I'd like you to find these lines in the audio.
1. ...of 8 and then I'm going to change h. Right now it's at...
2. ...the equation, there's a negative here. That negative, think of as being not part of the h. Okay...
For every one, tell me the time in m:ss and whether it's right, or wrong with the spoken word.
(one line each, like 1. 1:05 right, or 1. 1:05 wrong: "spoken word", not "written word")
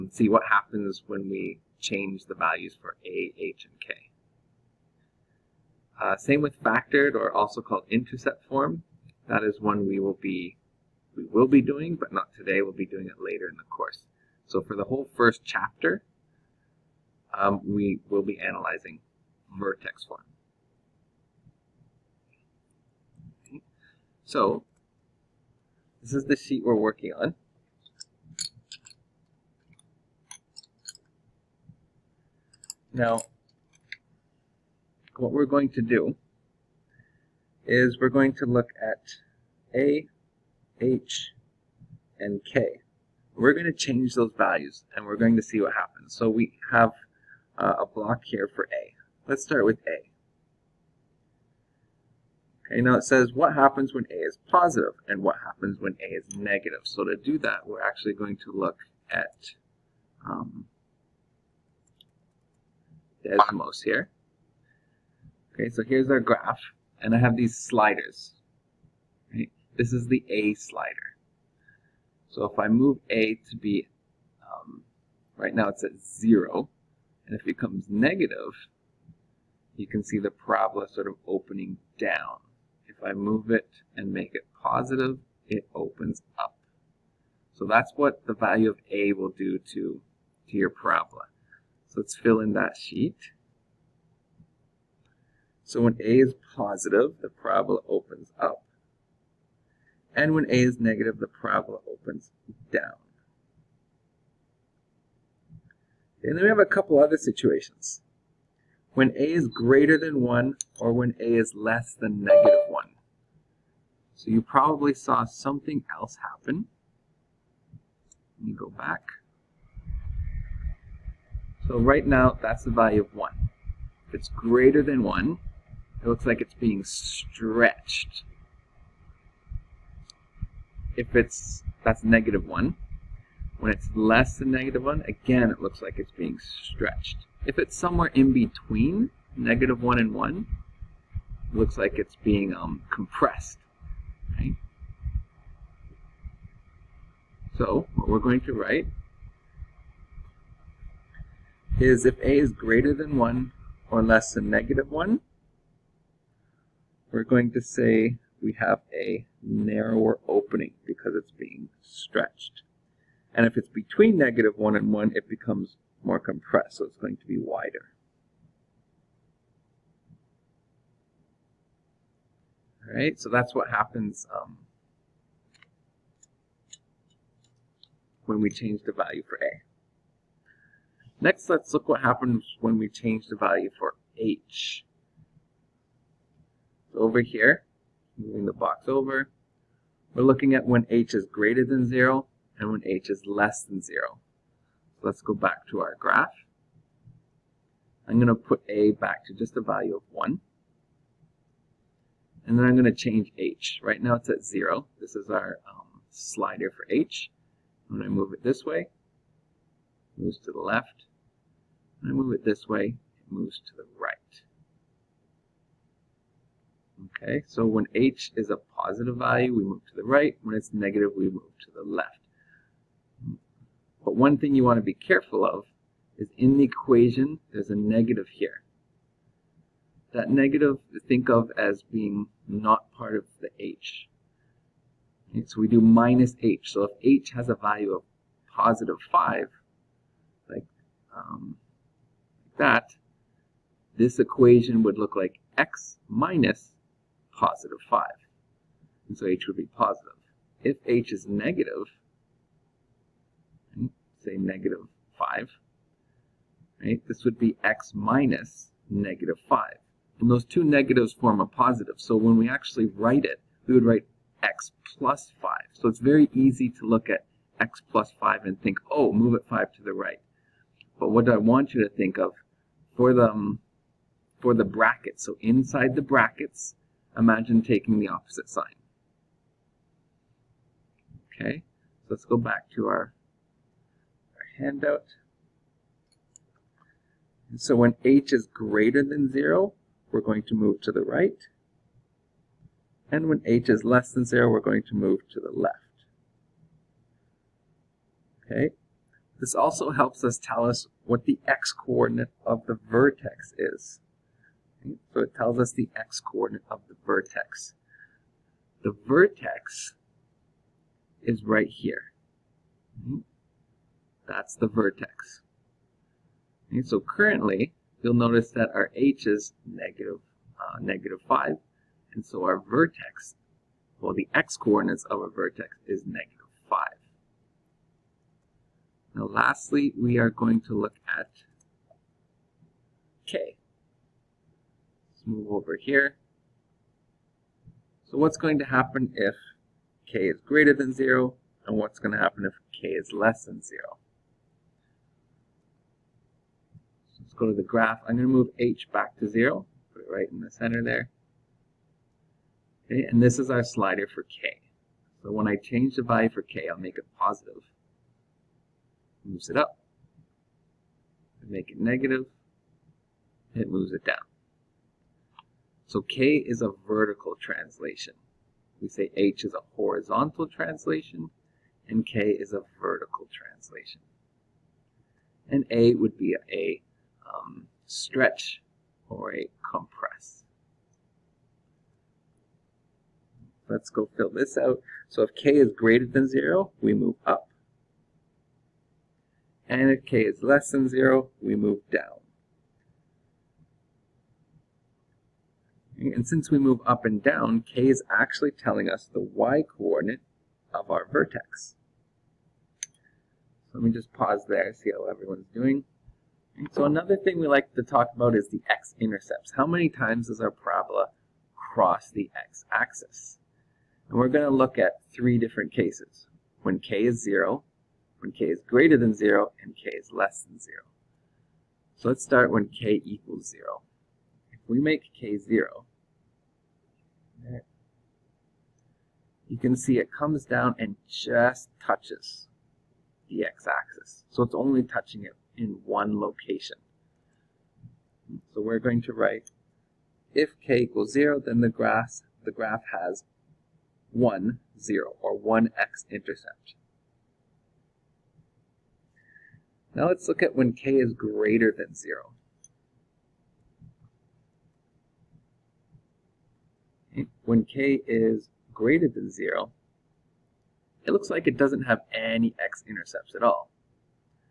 1. 3:19 wrong: "1", not "8"
2. 3:46 right.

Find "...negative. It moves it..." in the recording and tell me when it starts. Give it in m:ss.
6:01.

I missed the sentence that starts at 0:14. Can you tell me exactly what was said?
So for the whole first chapter, um, we will be analyzing vertex form.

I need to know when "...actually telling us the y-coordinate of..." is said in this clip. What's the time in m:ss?
6:38.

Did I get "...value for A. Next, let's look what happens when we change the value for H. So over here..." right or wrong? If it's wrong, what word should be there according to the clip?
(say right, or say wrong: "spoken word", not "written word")
right.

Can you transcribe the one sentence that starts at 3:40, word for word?
When it's negative, we move to the left.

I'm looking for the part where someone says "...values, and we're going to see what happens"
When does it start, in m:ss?
0:44.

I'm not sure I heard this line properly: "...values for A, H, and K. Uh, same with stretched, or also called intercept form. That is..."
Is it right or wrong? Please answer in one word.
wrong.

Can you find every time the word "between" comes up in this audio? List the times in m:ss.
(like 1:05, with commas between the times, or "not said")
2:18, 2:43.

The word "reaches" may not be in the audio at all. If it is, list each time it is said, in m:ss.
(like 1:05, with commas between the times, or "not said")
not said.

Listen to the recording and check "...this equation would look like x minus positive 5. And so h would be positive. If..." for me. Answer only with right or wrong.
right.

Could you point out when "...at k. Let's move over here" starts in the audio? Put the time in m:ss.
5:31.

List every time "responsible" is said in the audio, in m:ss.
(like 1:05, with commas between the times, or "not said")
not said.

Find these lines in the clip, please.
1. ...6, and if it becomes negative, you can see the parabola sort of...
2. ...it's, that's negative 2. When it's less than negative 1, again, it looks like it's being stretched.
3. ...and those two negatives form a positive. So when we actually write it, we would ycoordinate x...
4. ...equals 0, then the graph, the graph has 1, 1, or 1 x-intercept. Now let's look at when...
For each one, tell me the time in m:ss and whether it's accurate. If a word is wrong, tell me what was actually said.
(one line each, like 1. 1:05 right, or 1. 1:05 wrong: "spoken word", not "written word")
1. 1:15 wrong: "0", not "6"
2. 2:11 wrong: "1", not "2"
3. 4:20 wrong: "write", not "ycoordinate"
4. 7:20 wrong: "0", not "1".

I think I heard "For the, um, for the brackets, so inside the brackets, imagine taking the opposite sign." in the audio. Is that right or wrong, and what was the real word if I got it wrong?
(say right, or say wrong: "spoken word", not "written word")
right.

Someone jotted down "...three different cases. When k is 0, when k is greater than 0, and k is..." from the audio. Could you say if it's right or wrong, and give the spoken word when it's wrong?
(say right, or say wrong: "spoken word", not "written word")
right.